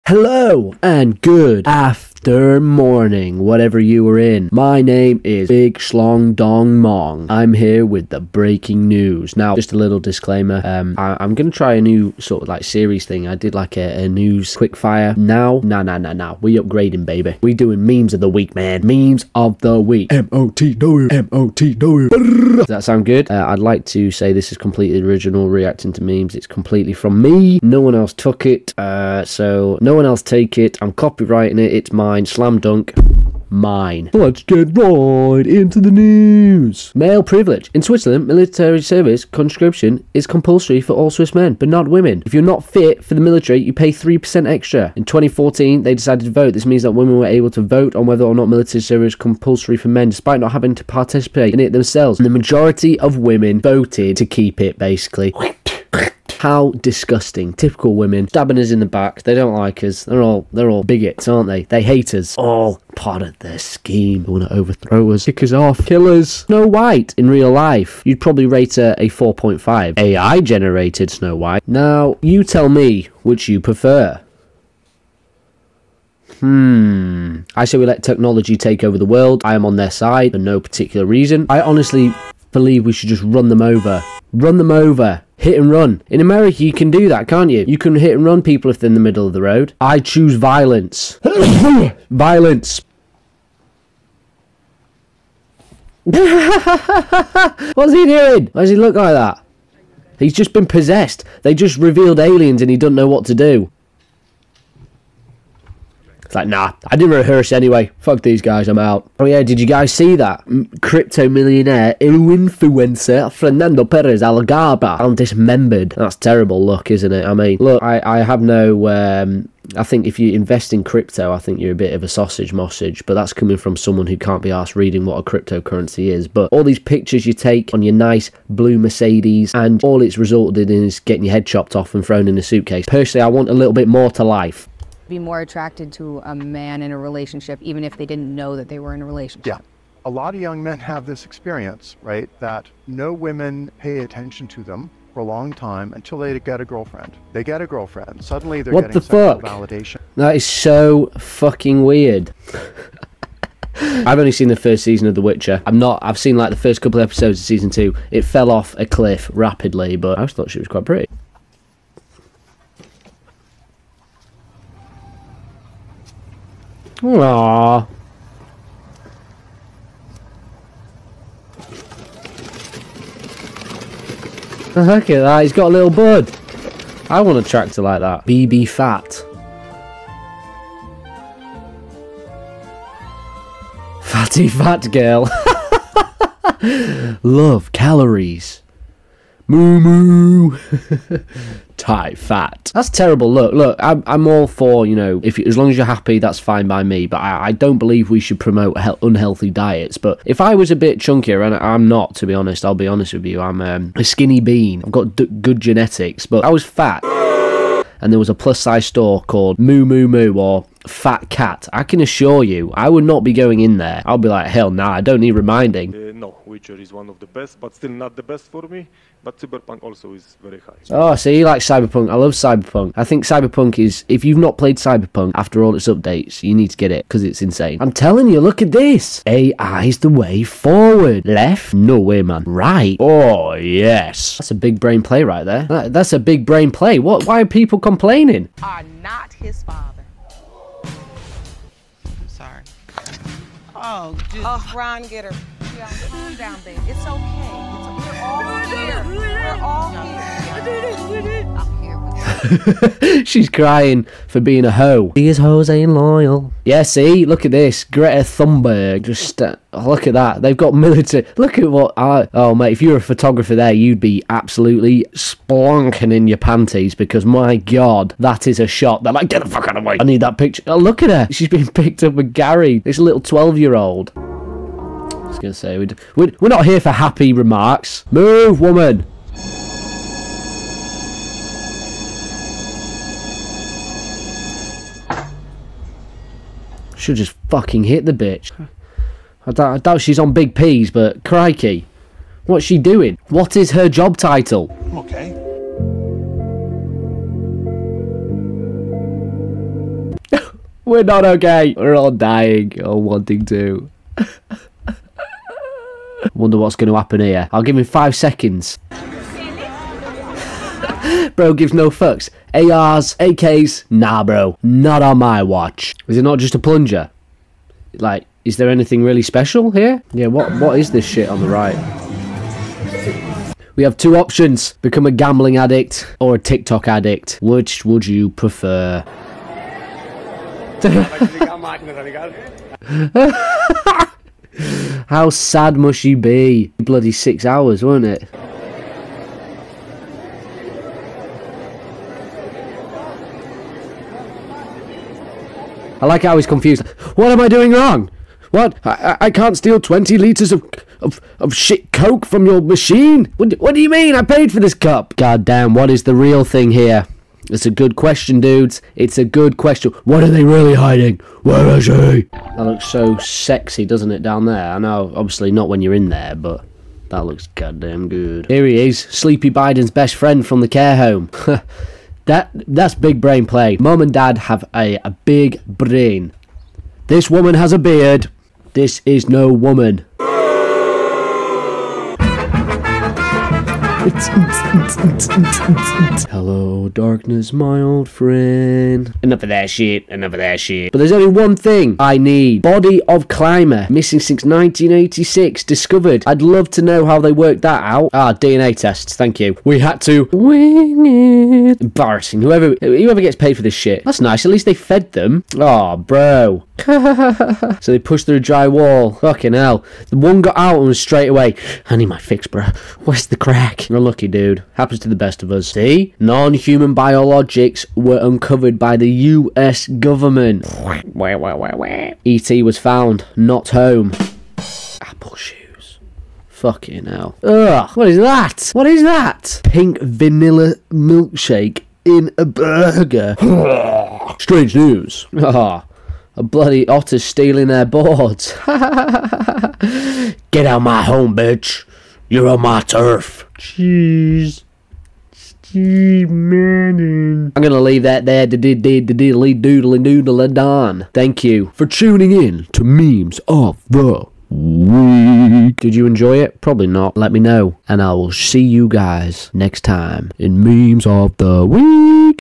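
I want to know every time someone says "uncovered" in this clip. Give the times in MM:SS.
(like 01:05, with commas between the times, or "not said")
06:58.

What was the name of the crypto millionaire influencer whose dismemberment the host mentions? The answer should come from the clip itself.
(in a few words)
Fernando Perez Algaba.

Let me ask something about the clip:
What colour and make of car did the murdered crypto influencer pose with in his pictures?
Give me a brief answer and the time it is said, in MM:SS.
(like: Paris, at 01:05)
Blue Mercedes, at 02:08.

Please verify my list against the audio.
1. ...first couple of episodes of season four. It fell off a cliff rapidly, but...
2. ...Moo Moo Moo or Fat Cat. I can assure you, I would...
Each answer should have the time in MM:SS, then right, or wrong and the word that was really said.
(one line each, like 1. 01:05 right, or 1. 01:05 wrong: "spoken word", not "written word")
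1. 02:36 wrong: "two", not "four"
2. 03:29 right.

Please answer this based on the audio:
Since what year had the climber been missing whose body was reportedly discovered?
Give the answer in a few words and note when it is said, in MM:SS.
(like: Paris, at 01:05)
1986, at 06:34.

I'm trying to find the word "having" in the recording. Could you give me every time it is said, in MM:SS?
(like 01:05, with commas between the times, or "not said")
00:50.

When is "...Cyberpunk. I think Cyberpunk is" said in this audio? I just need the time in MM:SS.
03:42.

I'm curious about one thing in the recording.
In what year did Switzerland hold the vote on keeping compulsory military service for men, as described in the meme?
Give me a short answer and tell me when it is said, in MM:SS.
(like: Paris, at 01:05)
2014, at 00:45.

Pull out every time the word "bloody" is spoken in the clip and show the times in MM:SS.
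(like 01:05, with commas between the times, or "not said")
05:36, 07:16.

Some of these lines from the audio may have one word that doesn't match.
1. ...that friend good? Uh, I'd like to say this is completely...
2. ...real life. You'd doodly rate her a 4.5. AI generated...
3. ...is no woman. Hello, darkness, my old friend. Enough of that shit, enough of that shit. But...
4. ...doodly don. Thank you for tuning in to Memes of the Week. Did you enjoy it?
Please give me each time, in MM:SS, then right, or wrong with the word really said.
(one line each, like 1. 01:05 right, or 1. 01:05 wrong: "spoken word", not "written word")
1. 00:22 wrong: "sound", not "friend"
2. 01:07 wrong: "probably", not "doodly"
3. 06:19 right
4. 07:30 right.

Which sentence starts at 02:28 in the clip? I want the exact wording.
Suddenly they're what getting the fuck?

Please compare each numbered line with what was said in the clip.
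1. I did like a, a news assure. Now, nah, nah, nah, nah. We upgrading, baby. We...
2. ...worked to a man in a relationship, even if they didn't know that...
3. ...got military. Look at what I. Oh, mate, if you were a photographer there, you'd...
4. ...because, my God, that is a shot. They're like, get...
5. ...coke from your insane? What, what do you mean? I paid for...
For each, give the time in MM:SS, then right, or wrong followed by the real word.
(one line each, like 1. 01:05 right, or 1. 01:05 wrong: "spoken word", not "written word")
1. 00:13 wrong: "quickfire", not "assure"
2. 02:15 wrong: "attracted", not "worked"
3. 04:20 right
4. 04:26 right
5. 05:51 wrong: "machine", not "insane".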